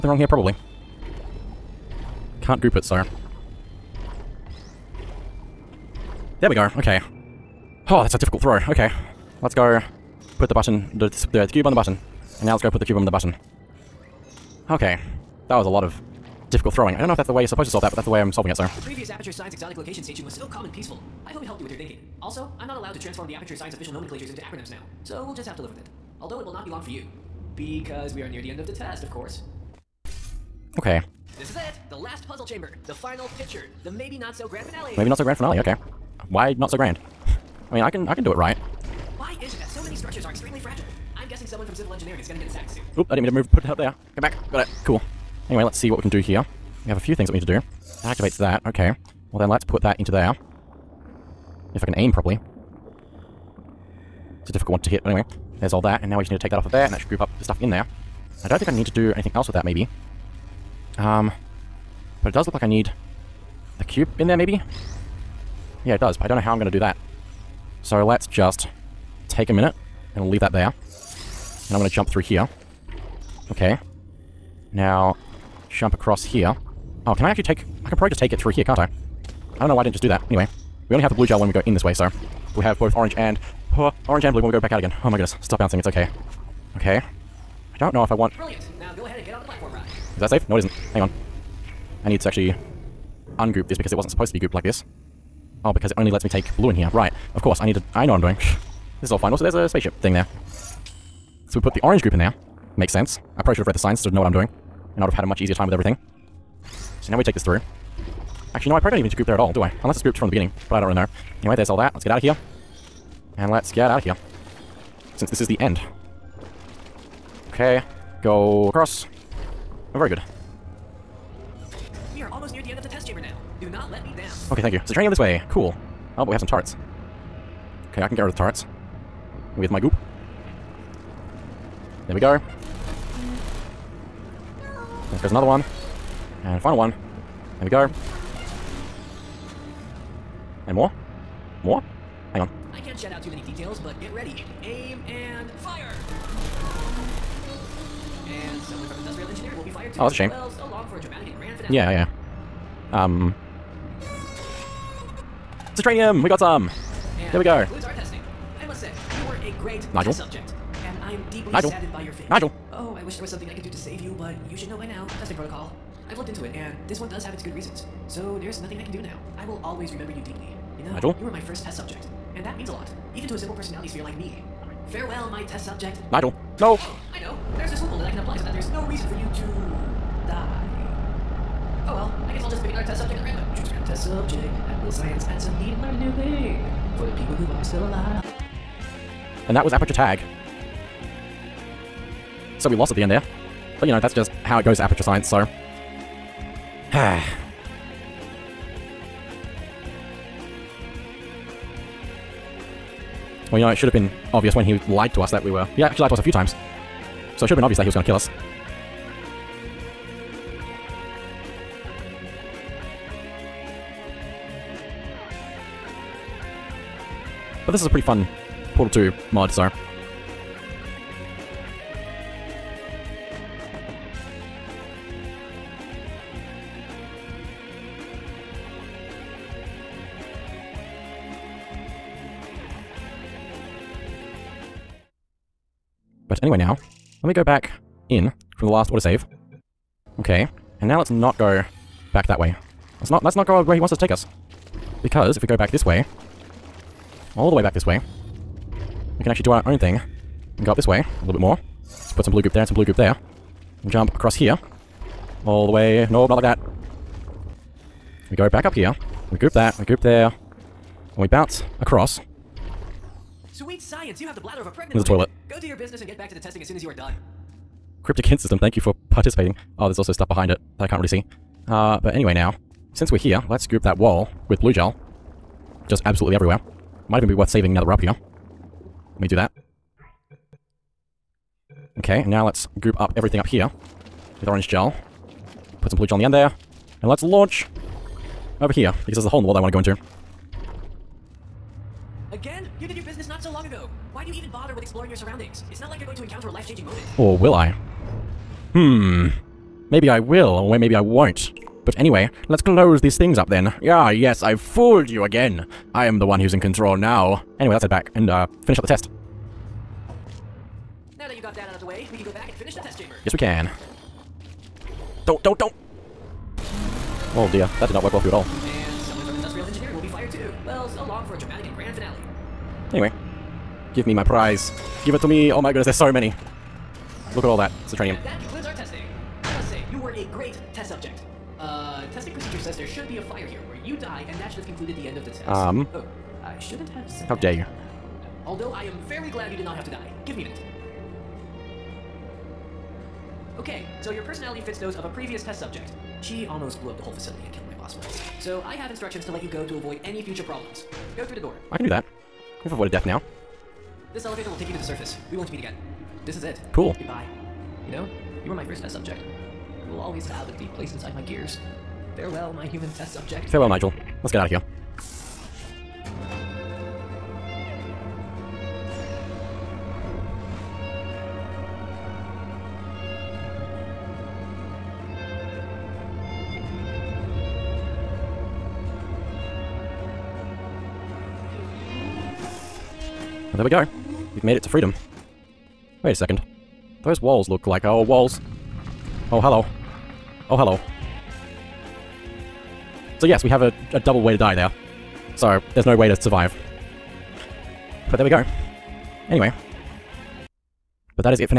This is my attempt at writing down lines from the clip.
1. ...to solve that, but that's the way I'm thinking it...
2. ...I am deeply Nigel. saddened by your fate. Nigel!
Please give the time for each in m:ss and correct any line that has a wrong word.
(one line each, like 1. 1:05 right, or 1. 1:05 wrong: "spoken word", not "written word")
1. 0:17 wrong: "solving", not "thinking"
2. 2:41 right.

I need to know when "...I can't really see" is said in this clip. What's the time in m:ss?
4:30.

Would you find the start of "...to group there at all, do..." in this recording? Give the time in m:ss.
1:49.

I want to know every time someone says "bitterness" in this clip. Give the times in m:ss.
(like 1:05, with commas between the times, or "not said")
not said.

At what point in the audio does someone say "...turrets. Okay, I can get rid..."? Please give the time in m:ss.
2:06.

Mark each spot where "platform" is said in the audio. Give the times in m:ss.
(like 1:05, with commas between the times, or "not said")
1:29.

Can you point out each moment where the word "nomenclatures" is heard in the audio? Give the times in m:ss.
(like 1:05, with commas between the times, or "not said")
0:23.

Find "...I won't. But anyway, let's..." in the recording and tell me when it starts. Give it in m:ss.
5:00.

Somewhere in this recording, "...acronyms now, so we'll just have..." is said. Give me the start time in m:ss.
0:24.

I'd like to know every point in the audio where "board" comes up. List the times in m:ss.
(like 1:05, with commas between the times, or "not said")
not said.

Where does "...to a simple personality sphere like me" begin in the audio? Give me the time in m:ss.
2:53.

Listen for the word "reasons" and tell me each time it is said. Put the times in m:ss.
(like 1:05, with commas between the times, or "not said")
2:47, 2:58.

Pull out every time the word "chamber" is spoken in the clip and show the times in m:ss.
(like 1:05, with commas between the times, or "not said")
0:32, 2:03, 5:12.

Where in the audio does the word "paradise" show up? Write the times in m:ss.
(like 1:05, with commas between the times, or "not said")
not said.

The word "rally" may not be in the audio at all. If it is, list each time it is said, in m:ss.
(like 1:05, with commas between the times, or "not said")
not said.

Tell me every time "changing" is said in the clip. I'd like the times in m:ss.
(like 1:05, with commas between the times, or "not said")
4:56.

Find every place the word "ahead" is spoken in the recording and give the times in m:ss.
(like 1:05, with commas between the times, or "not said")
1:29.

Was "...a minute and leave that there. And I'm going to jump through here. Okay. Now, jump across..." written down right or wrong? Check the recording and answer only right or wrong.
right.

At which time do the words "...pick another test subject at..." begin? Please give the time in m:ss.
3:02.